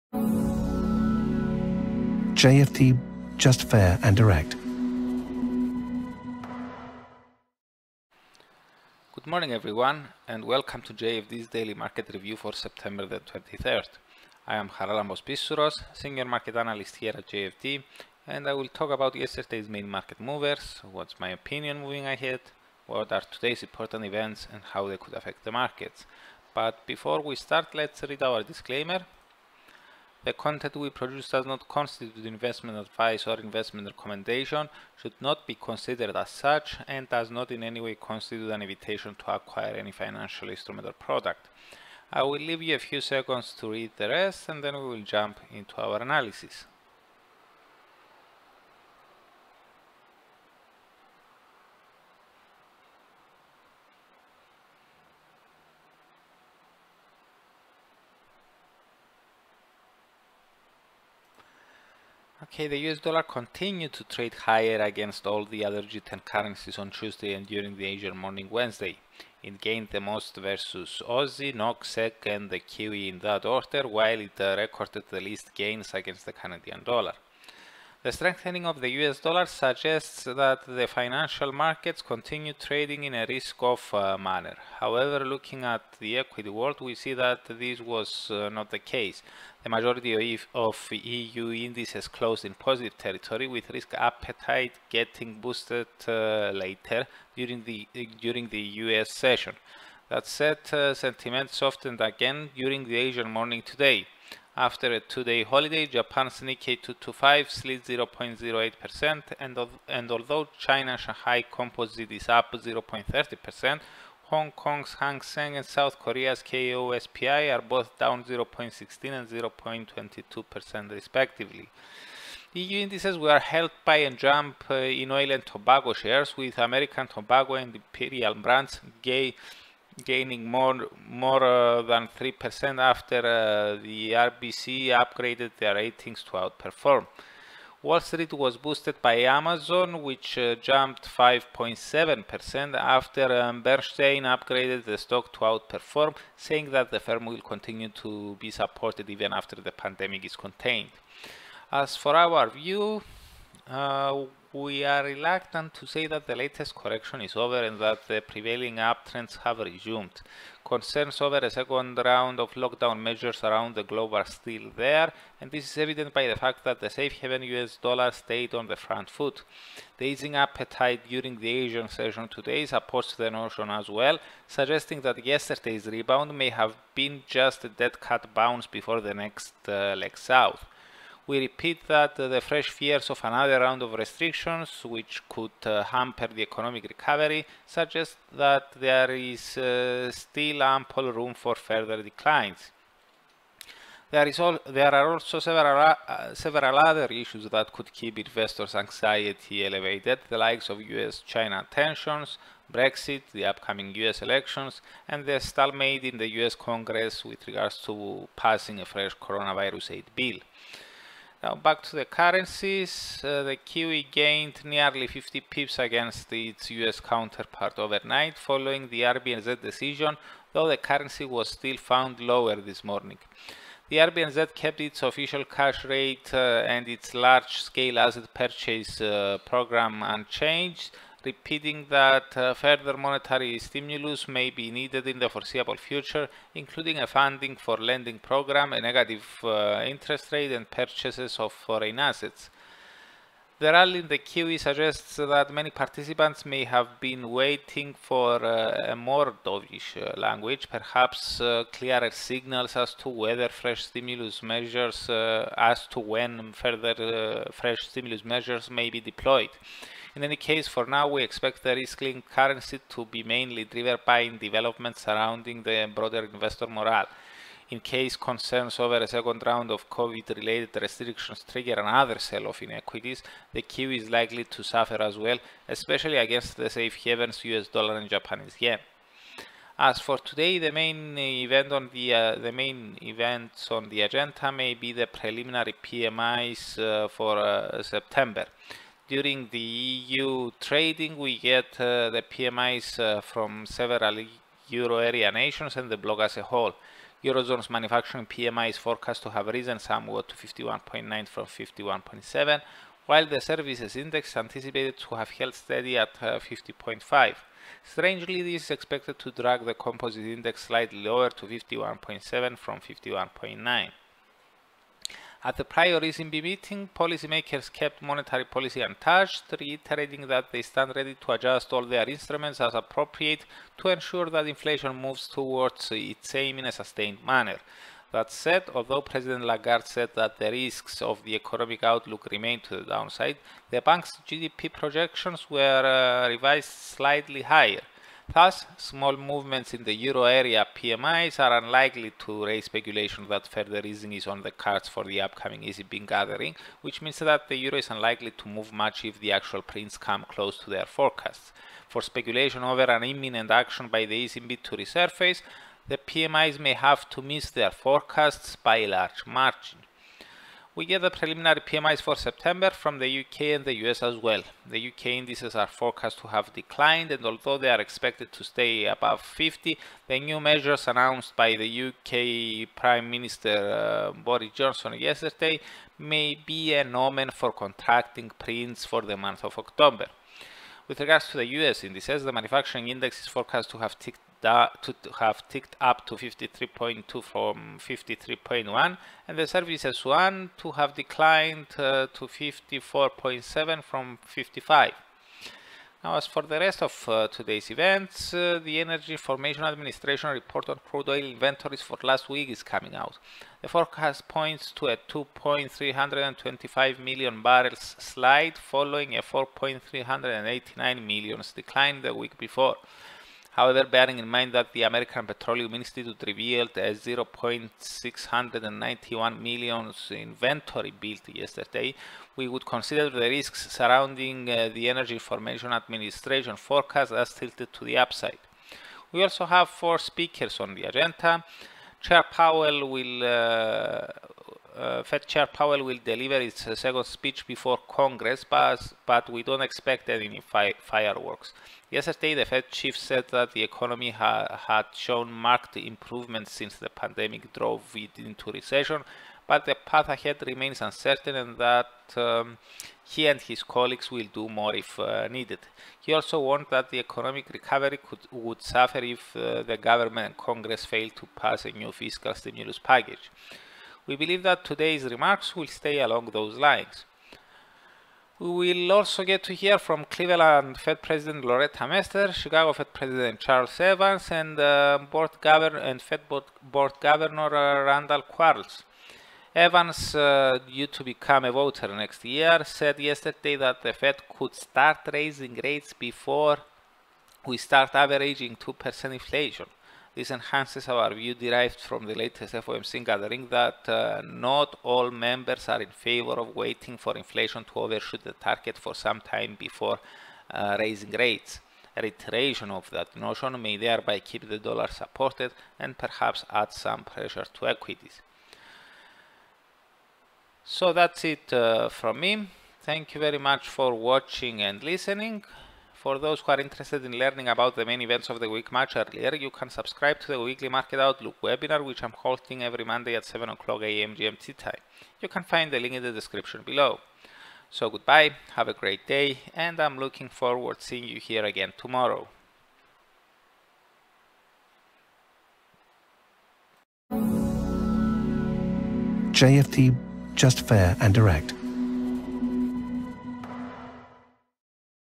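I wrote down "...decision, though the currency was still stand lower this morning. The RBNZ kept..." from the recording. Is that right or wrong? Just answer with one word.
wrong.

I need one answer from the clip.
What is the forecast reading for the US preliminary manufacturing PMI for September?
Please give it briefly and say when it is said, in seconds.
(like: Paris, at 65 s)
53.2, at 386 s.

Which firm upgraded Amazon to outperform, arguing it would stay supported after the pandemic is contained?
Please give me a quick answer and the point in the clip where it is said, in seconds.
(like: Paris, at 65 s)
Bernstein, at 143 s.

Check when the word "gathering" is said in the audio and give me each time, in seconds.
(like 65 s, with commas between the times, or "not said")
346 s, 493 s.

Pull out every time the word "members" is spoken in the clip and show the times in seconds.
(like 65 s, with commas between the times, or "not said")
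495 s.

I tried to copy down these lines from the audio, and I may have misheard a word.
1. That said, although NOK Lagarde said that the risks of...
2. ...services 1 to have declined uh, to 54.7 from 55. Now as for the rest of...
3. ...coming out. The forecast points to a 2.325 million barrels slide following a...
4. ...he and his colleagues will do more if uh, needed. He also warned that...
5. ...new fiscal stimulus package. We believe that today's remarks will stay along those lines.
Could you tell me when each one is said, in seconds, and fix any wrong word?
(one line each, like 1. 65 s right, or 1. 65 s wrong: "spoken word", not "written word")
1. 328 s wrong: "President", not "NOK"
2. 389 s right
3. 402 s right
4. 453 s right
5. 461 s right.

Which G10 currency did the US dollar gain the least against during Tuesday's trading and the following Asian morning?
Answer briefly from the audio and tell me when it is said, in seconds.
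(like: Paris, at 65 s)
Canadian dollar, at 76 s.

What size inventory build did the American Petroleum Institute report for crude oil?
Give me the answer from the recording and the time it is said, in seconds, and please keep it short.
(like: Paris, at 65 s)
0.691 million barrels, at 416 s.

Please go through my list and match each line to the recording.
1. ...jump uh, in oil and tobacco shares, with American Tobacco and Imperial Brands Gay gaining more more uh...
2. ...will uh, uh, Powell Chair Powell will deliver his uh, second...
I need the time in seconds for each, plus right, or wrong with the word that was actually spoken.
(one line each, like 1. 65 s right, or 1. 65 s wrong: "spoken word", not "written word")
1. 124 s right
2. 432 s wrong: "Fed", not "Powell".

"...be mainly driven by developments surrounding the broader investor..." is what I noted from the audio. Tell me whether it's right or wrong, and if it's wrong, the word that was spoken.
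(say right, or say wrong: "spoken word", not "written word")
right.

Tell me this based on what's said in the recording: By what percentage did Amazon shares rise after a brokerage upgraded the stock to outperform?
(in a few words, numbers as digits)
5.7%.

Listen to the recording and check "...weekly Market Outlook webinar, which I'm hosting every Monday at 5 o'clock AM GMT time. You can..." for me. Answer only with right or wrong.
wrong.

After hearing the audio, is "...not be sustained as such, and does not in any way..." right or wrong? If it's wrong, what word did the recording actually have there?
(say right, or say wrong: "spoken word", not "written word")
wrong: "considered", not "sustained".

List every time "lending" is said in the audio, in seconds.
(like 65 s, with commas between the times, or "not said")
237 s.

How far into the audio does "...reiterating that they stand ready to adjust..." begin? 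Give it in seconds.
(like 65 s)
319 s.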